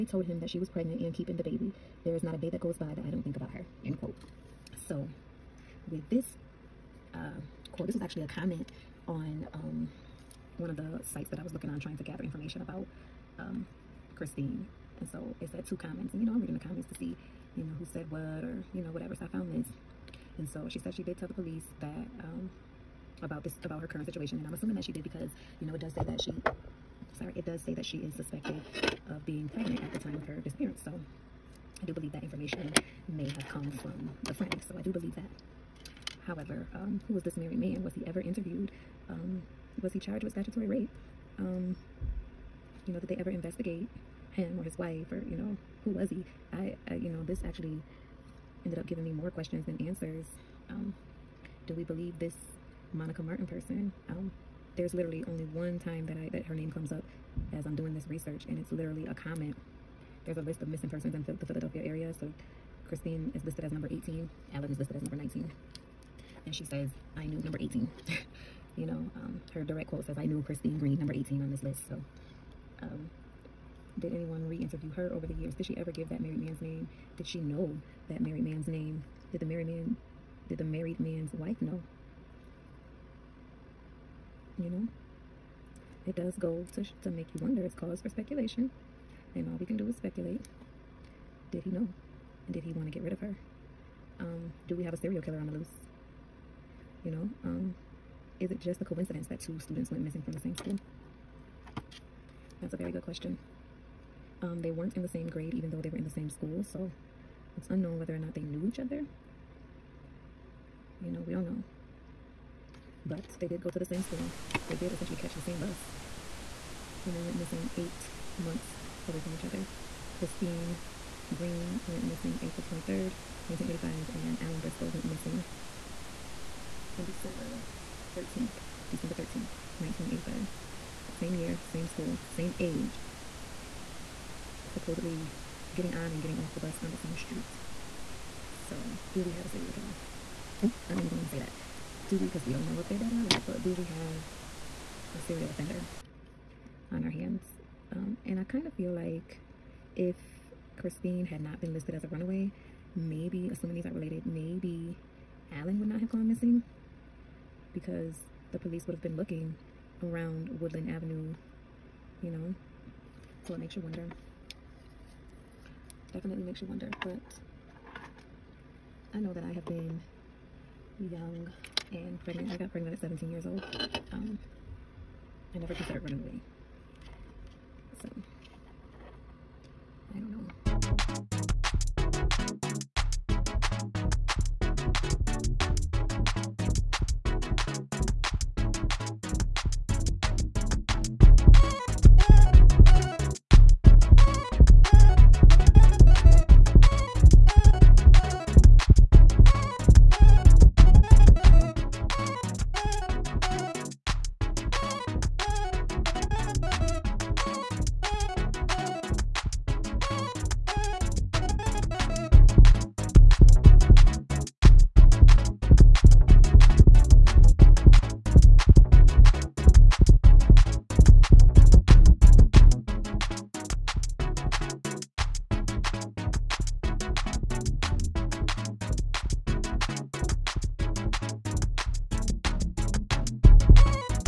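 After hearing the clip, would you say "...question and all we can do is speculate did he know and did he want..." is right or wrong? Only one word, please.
wrong.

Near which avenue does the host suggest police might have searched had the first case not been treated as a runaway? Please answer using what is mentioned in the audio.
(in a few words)
Woodland Avenue.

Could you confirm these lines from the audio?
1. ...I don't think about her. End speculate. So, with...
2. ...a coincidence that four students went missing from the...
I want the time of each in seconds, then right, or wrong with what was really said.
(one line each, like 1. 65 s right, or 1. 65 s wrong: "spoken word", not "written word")
1. 3 s wrong: "quote", not "speculate"
2. 98 s wrong: "two", not "four".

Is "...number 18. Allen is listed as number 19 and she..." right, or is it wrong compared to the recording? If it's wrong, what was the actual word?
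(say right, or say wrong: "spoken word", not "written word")
right.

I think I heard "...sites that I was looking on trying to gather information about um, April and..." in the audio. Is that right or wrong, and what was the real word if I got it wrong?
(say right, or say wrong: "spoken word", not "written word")
wrong: "Christine", not "April".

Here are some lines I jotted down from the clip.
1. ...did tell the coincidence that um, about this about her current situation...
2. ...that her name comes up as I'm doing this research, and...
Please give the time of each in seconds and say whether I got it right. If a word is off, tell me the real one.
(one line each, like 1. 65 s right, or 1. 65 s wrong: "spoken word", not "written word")
1. 21 s wrong: "police", not "coincidence"
2. 56 s right.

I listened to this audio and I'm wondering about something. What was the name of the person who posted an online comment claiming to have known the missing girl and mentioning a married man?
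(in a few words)
Monica Martin.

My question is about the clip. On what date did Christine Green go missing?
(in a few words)
April 23rd, 1985.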